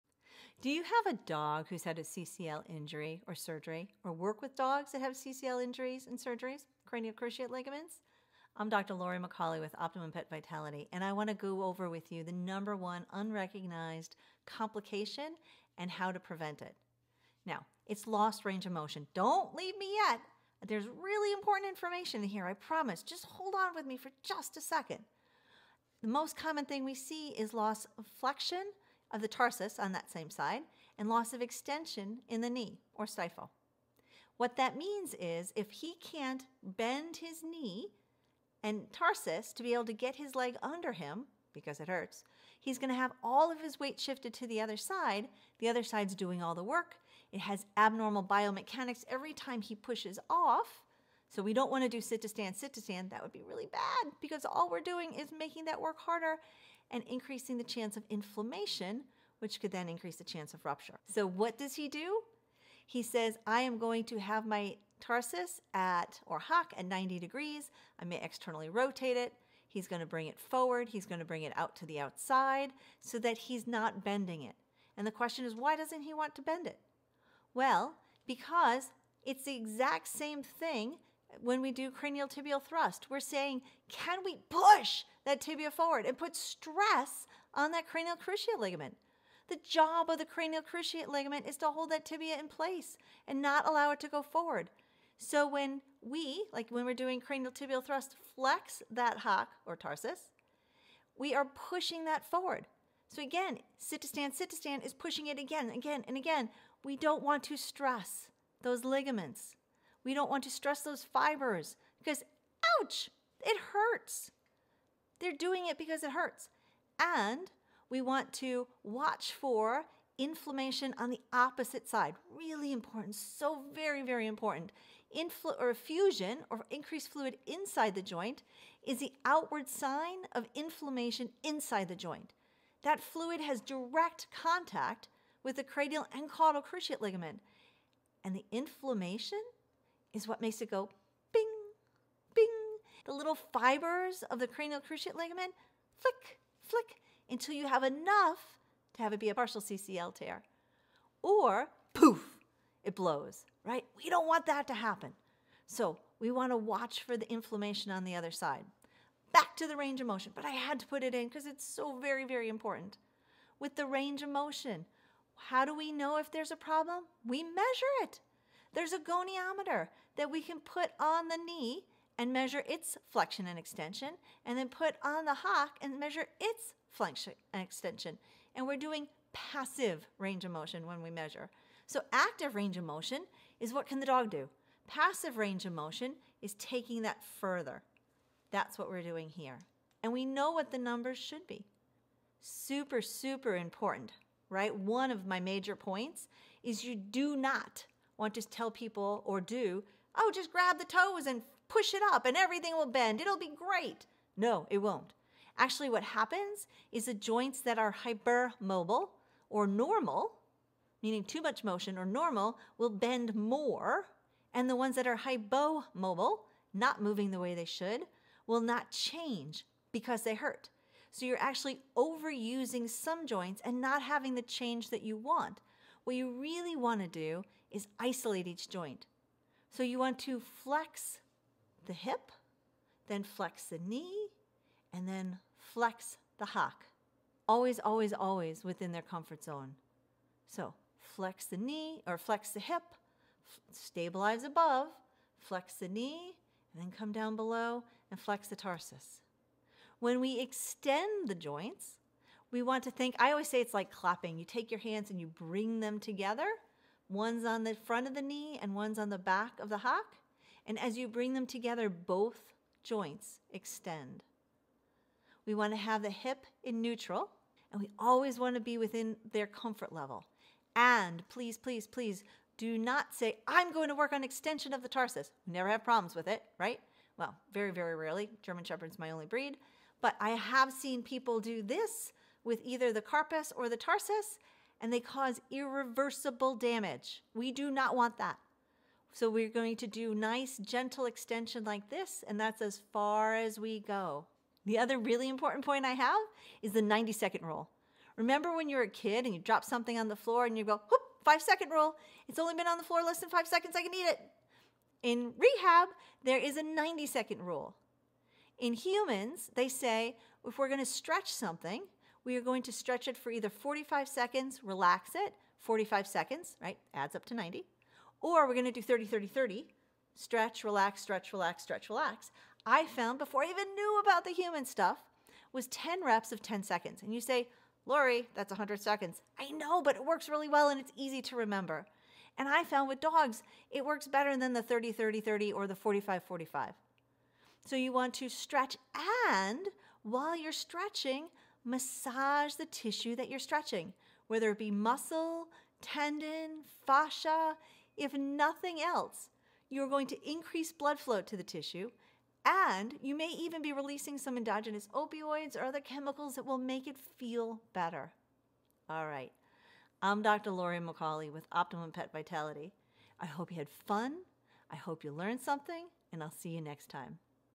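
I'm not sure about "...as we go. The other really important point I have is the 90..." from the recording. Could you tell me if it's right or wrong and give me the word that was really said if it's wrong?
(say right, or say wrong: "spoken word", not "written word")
right.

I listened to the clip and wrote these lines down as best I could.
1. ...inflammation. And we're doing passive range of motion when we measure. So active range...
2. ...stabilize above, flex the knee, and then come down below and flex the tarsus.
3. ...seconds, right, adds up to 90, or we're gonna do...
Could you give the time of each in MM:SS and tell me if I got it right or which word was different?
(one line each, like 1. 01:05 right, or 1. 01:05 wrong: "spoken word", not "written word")
1. 02:57 wrong: "extension", not "inflammation"
2. 04:03 right
3. 05:16 right.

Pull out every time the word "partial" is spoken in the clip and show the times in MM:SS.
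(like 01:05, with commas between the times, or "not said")
02:29.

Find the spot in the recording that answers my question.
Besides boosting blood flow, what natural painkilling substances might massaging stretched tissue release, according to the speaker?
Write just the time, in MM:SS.
05:54.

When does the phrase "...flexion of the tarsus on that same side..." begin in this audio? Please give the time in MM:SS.
00:28.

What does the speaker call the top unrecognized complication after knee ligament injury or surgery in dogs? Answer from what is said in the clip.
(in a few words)
Lost range of motion.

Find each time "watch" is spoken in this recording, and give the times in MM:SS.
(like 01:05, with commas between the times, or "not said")
01:58, 02:36.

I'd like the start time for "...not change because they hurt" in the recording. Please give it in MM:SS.
03:38.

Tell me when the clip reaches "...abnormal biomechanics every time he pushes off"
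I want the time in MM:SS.
00:47.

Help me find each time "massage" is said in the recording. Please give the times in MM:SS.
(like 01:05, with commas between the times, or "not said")
05:41.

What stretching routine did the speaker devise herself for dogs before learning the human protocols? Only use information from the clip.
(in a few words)
10 reps of 10 seconds.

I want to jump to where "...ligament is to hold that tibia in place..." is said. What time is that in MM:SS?
01:31.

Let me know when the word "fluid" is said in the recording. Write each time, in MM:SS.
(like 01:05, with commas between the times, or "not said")
02:07, 02:13.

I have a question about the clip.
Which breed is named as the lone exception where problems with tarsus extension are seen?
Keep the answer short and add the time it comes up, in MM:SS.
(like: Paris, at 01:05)
German Shepherd, at 04:38.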